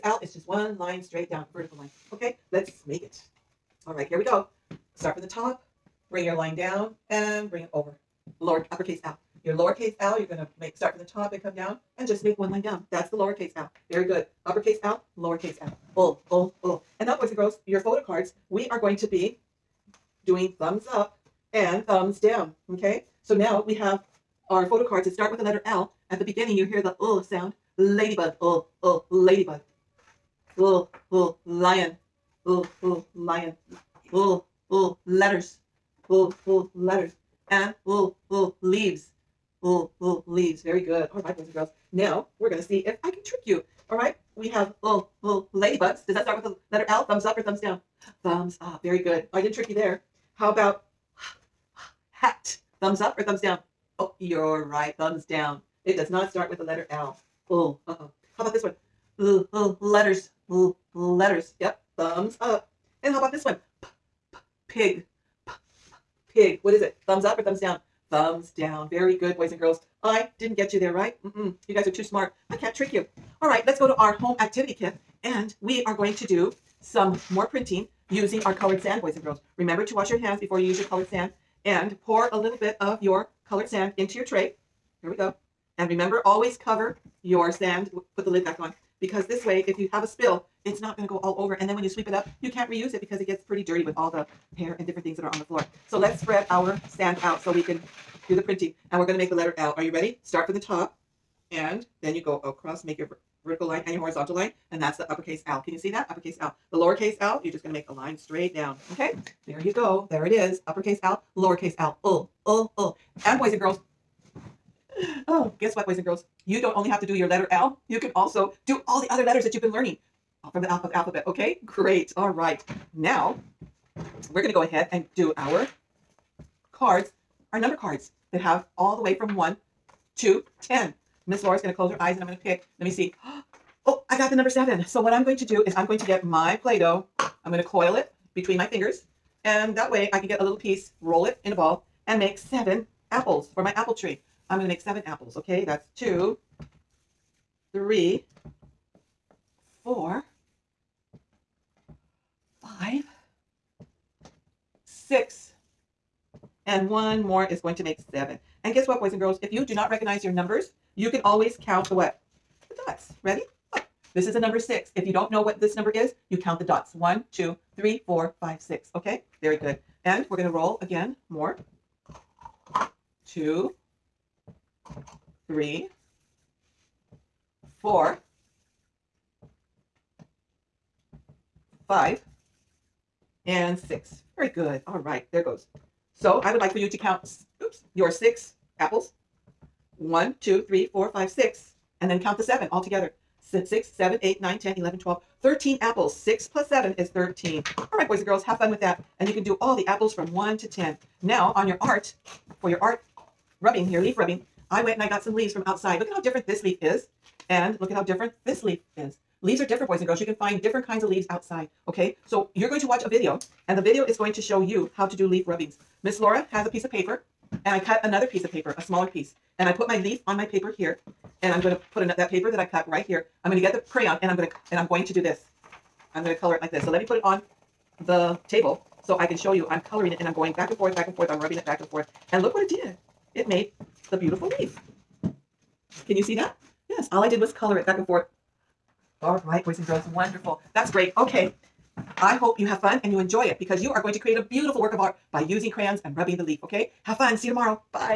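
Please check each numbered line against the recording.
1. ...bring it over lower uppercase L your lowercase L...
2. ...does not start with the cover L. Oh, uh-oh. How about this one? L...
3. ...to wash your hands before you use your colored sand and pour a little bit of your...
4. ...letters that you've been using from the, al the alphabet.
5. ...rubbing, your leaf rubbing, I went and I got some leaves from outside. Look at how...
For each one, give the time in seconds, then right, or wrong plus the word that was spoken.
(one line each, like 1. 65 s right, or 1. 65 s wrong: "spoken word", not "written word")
1. 7 s right
2. 55 s wrong: "letter", not "cover"
3. 79 s right
4. 119 s wrong: "learning", not "using"
5. 203 s right.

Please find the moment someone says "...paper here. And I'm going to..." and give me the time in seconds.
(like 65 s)
220 s.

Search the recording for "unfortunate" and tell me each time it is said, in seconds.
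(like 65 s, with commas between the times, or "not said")
not said.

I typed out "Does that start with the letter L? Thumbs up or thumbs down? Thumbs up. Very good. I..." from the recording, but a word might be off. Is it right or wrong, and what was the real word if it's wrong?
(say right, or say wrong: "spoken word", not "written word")
right.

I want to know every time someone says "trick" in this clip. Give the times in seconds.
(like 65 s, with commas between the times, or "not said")
43 s, 49 s, 72 s.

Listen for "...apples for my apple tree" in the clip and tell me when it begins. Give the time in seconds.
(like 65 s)
143 s.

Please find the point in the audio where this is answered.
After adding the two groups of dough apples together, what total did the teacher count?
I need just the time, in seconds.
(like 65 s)
195 s.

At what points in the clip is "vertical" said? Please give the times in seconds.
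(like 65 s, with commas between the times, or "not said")
1 s, 103 s.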